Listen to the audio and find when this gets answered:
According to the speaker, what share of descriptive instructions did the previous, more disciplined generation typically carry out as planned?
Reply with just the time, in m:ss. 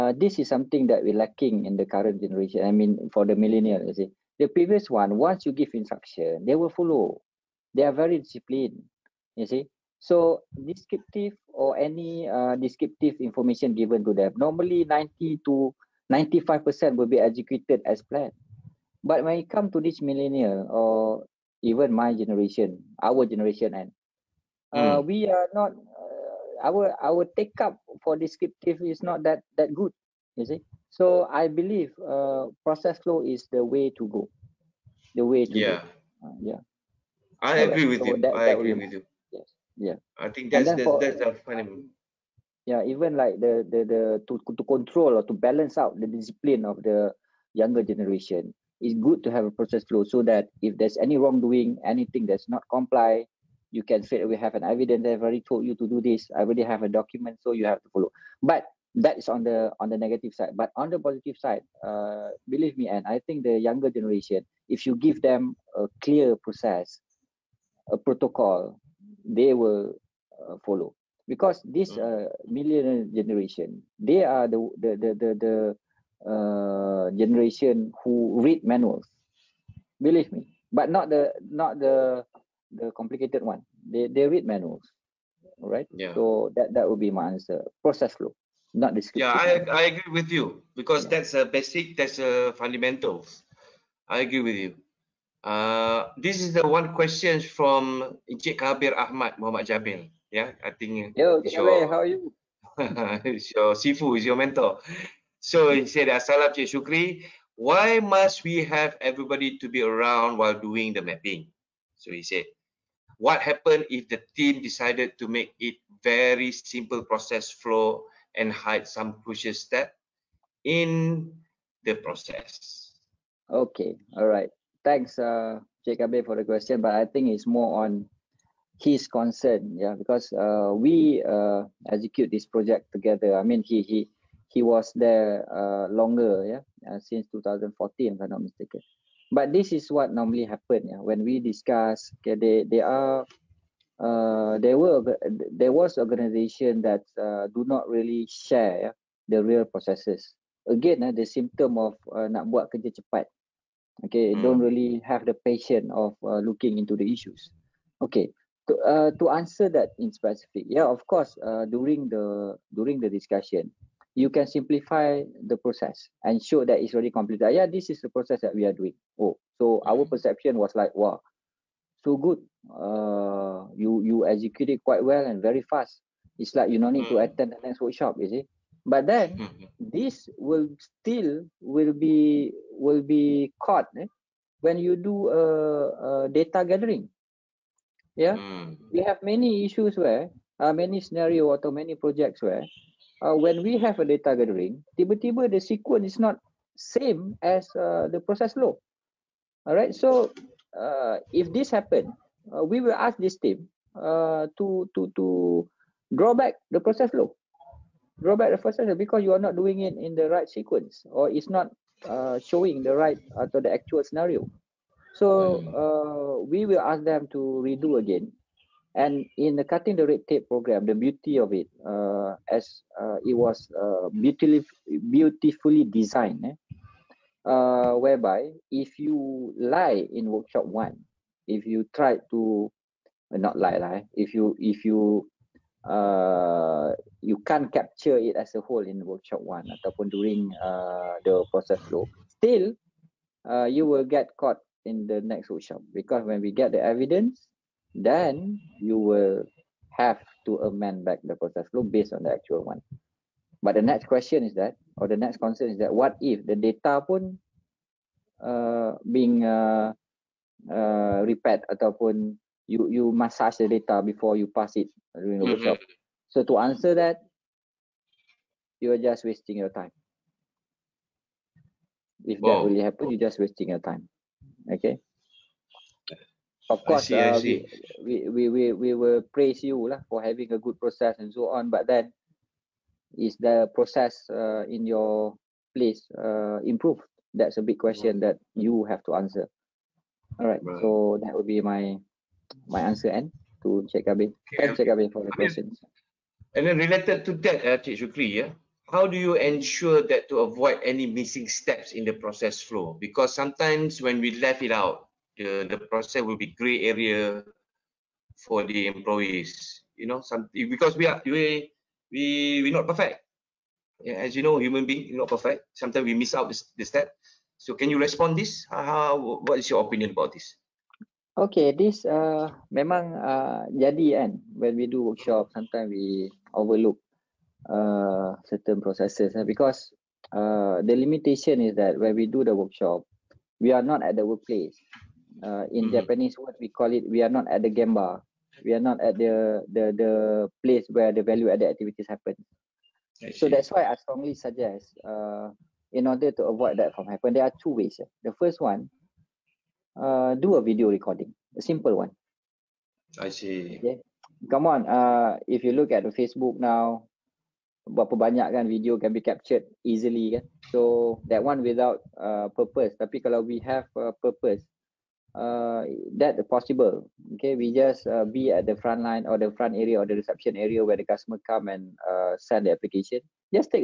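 0:14.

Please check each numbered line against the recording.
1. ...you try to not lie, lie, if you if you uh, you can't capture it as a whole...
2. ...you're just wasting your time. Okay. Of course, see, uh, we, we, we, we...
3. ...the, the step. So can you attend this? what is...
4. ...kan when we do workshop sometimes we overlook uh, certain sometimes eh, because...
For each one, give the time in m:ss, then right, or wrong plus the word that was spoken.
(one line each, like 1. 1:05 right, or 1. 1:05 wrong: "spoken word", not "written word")
1. 3:51 right
2. 4:33 right
3. 5:16 wrong: "respond", not "attend"
4. 5:24 wrong: "processes", not "sometimes".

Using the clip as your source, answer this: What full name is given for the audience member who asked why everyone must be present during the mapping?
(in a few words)
Kabir Ahmad Muhammad Jabil.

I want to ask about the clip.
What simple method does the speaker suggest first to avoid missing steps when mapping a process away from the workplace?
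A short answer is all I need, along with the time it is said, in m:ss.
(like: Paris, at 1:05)
Video recording, at 5:50.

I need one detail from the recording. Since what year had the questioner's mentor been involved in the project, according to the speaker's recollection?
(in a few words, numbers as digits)
2014.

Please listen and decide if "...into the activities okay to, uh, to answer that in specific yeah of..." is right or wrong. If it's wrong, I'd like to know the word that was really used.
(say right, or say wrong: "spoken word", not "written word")
wrong: "issues", not "activities".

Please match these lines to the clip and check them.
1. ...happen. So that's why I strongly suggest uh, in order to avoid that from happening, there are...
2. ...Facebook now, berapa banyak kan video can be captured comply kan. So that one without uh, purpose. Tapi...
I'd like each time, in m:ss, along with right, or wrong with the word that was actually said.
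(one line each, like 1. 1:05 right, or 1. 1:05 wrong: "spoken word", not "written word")
1. 5:42 right
2. 5:56 wrong: "easily", not "comply".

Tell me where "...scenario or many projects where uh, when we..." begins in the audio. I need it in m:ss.
3:11.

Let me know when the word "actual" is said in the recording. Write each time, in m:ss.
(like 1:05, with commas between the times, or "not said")
3:33, 4:12.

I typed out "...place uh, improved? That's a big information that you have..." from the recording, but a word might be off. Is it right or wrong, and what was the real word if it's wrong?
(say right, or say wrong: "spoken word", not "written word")
wrong: "question", not "information".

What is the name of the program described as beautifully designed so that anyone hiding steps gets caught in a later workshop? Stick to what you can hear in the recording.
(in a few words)
Cutting the red tape.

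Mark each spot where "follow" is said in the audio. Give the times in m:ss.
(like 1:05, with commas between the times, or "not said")
0:06, 0:57, 1:10.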